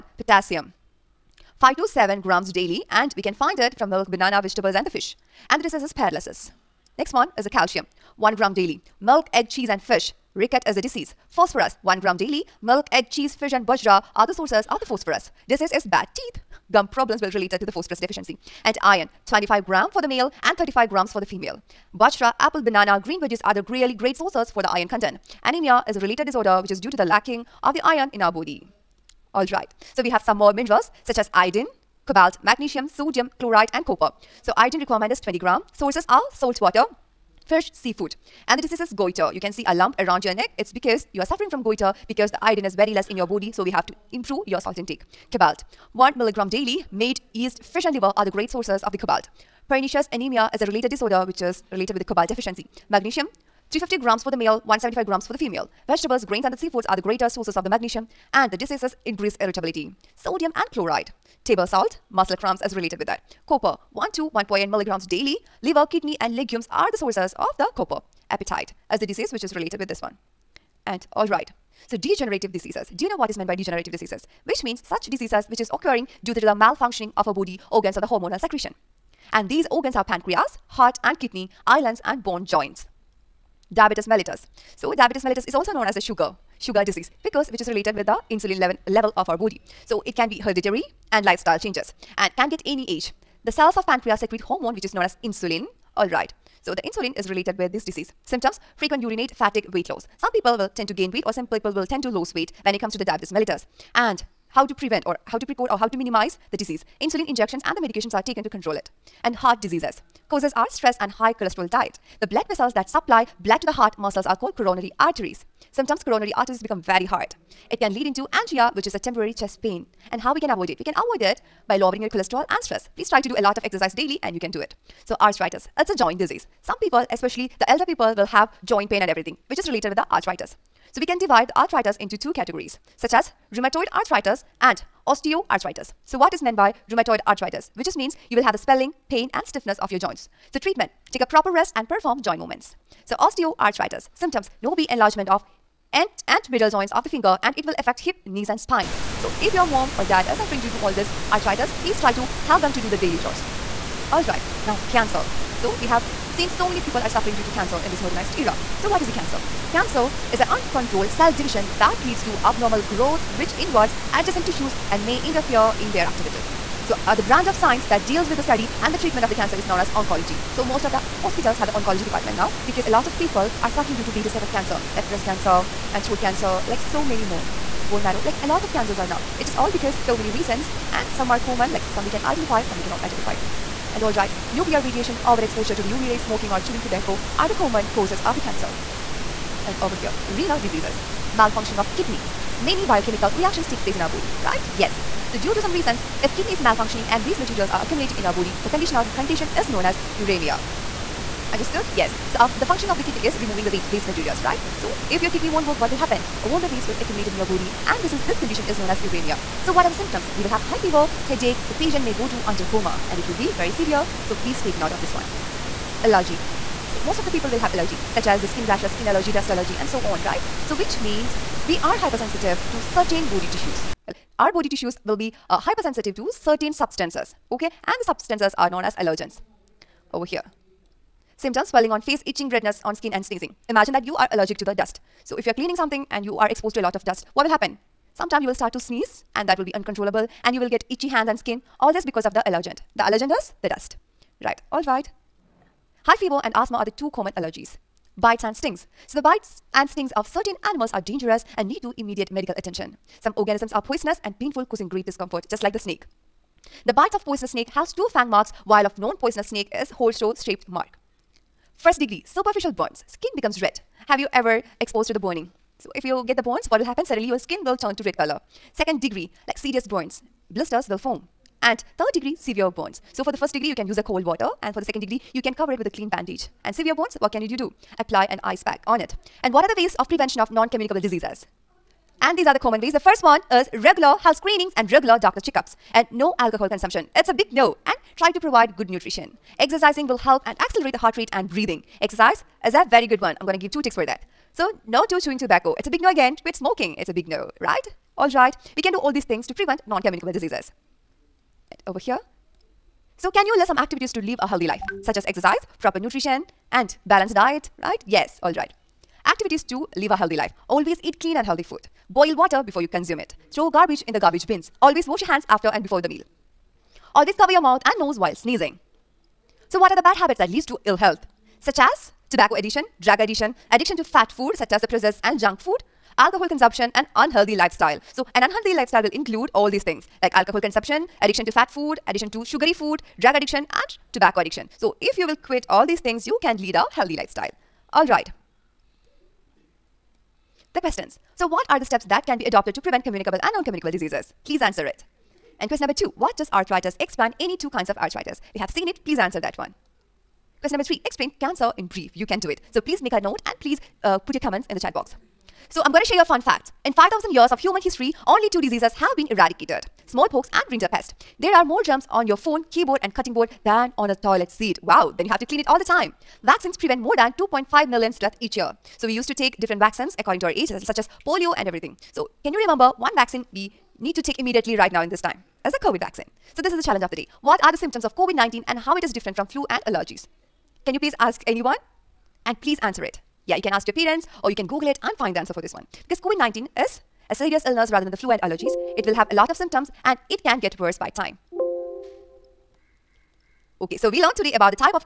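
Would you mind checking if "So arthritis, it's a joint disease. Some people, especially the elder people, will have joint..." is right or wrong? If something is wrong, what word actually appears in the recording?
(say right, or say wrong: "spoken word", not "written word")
right.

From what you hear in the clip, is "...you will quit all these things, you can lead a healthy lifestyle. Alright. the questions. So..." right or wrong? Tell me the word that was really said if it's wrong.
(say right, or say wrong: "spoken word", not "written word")
right.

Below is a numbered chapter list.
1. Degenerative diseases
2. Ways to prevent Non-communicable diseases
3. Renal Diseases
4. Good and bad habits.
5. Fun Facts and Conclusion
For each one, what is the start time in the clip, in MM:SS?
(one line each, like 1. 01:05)
1. 01:11
2. 04:41
3. 03:09
4. 05:04
5. 05:55.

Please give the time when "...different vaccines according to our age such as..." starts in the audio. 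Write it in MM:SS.
06:09.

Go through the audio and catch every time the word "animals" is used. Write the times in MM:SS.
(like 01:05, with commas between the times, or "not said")
04:10.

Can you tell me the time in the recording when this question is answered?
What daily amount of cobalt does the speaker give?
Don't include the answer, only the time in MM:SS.
00:45.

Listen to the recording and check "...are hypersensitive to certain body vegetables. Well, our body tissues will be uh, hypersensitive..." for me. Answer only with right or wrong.
wrong.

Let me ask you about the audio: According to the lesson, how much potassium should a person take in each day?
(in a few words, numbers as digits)
5 to 7 grams.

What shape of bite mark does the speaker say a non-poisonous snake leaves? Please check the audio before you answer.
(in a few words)
Horseshoe shaped.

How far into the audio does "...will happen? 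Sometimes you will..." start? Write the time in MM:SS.
03:57.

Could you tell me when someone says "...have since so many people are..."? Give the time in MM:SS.
02:35.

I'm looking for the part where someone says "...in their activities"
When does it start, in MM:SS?
02:45.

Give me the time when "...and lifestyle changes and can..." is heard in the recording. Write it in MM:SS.
01:31.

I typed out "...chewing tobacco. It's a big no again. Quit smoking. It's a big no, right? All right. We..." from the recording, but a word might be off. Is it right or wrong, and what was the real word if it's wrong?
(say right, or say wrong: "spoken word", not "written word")
right.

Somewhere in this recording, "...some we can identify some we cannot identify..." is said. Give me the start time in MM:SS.
03:01.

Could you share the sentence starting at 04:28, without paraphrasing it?
Second degree, like serious burns, blisters will form.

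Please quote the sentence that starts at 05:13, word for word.
Throw garbage in the garbage bins.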